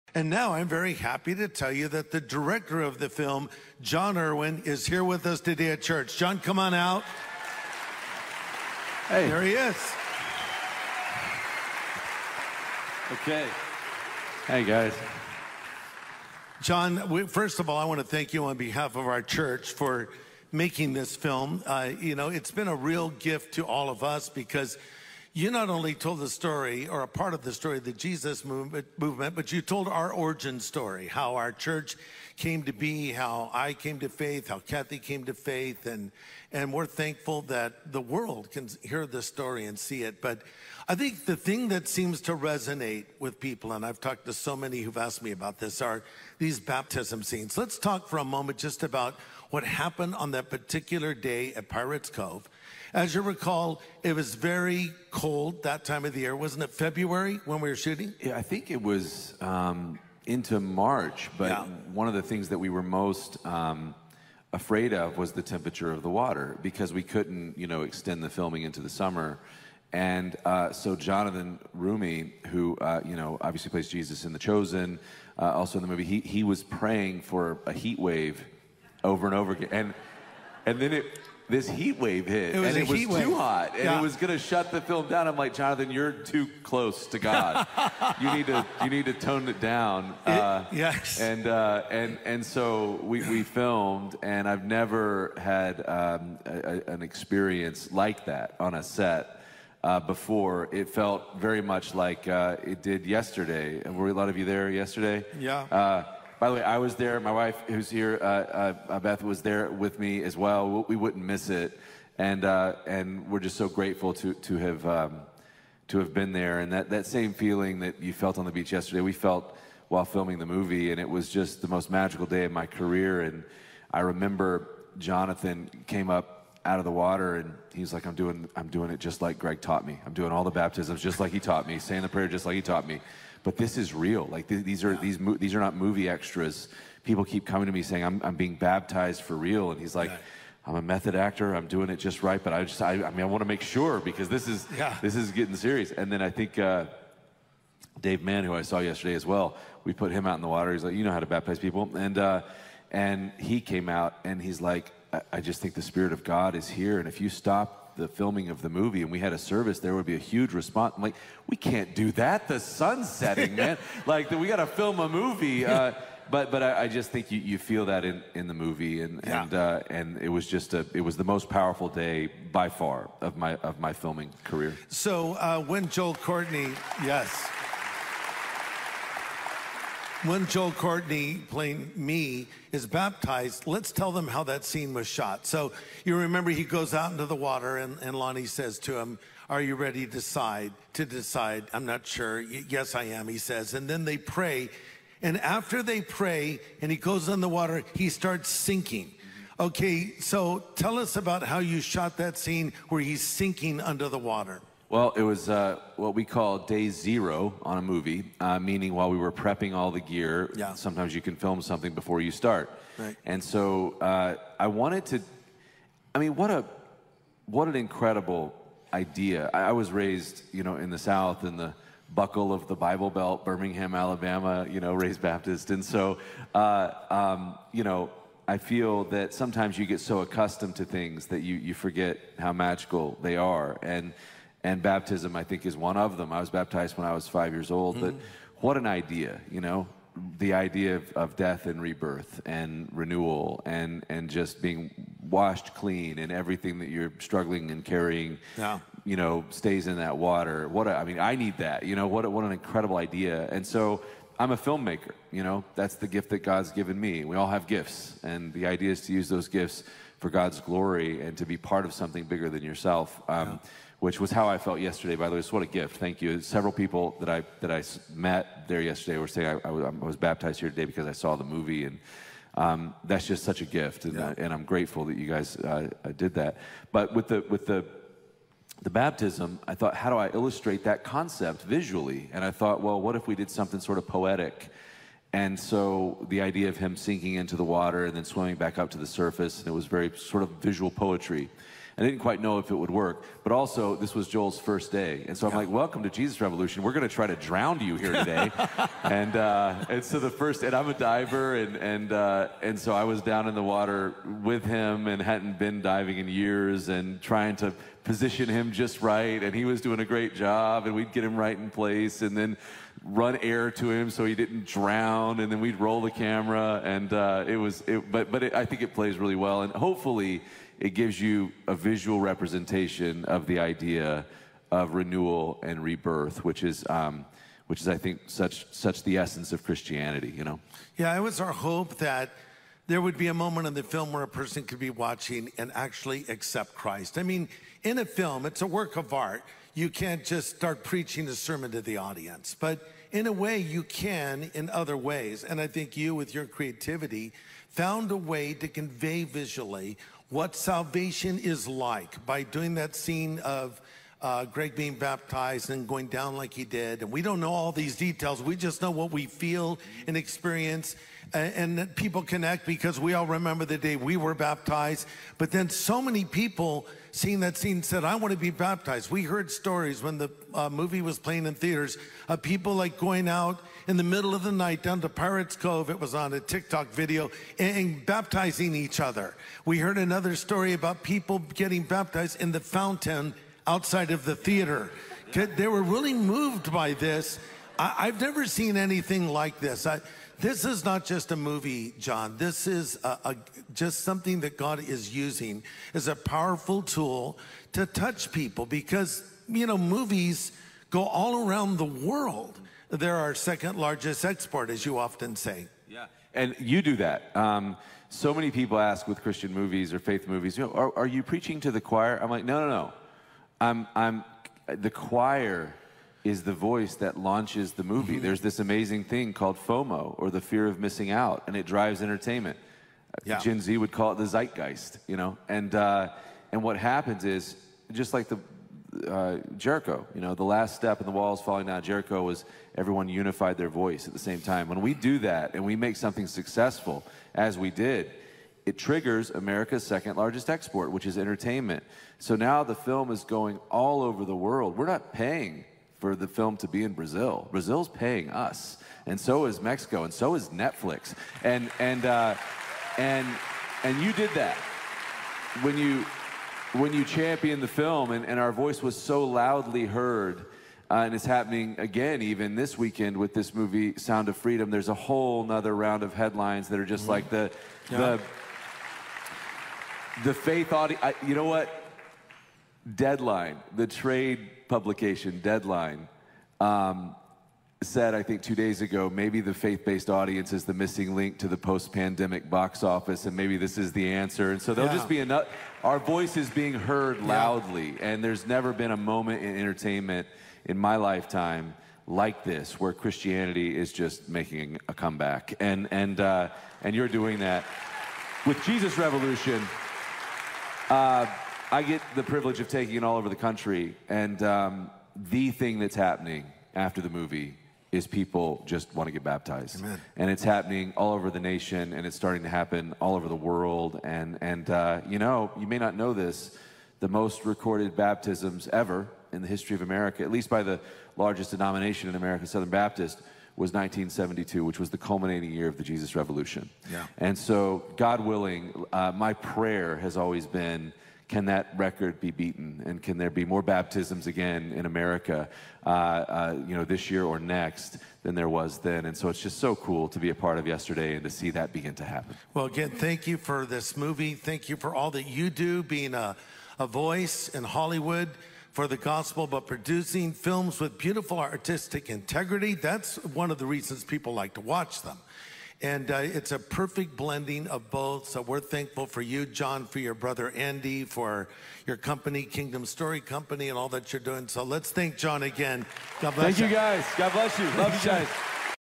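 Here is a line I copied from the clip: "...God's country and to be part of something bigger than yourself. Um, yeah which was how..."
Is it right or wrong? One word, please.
wrong.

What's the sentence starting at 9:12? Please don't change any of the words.
That's one of the reasons people like to watch them.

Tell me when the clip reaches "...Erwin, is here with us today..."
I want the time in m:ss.
0:04.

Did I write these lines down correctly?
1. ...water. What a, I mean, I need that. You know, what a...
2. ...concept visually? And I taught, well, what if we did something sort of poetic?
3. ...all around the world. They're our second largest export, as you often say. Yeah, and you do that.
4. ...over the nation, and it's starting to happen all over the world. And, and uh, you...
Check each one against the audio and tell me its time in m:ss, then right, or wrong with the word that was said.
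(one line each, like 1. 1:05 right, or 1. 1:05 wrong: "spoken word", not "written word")
1. 4:10 right
2. 4:41 wrong: "thought", not "taught"
3. 6:41 right
4. 8:31 right.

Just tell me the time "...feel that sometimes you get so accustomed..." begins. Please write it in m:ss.
3:48.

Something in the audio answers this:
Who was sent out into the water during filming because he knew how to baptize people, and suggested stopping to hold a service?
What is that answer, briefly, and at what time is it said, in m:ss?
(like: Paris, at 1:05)
Dave Mann, at 2:27.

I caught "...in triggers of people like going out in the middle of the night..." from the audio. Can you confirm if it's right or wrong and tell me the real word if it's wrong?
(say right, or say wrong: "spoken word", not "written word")
wrong: "theaters", not "triggers".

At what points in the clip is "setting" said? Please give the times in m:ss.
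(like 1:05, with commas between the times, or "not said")
2:43.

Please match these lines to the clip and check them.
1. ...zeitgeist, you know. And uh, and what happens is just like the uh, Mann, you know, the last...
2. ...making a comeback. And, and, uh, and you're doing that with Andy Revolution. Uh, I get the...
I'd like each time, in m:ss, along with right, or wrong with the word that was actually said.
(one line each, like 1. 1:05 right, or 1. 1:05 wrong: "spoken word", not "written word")
1. 7:04 wrong: "Jericho", not "Mann"
2. 8:14 wrong: "Jesus", not "Andy".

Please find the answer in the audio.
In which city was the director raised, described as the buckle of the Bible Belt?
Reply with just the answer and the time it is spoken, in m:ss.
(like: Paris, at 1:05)
Birmingham, Alabama, at 3:43.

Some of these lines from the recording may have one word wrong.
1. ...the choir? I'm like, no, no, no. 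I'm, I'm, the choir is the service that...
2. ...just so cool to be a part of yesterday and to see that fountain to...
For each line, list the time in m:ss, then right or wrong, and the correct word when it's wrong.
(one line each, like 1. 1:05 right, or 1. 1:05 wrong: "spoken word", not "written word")
1. 6:51 wrong: "voice", not "service"
2. 8:59 wrong: "begin", not "fountain".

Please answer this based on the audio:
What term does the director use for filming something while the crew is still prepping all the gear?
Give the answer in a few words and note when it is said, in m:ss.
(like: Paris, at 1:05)
day zero, at 3:26.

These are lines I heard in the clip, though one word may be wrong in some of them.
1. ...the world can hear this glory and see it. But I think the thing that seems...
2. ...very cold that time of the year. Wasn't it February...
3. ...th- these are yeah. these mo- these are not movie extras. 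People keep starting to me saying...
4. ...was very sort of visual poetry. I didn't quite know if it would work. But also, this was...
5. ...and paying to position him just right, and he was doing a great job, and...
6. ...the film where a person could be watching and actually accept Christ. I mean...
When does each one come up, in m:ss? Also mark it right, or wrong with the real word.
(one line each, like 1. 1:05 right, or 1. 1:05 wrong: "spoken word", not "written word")
1. 0:37 wrong: "story", not "glory"
2. 0:54 right
3. 2:14 wrong: "coming", not "starting"
4. 4:49 right
5. 5:06 wrong: "trying", not "paying"
6. 5:33 right.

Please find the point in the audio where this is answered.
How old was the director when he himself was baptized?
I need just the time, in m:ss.
3:57.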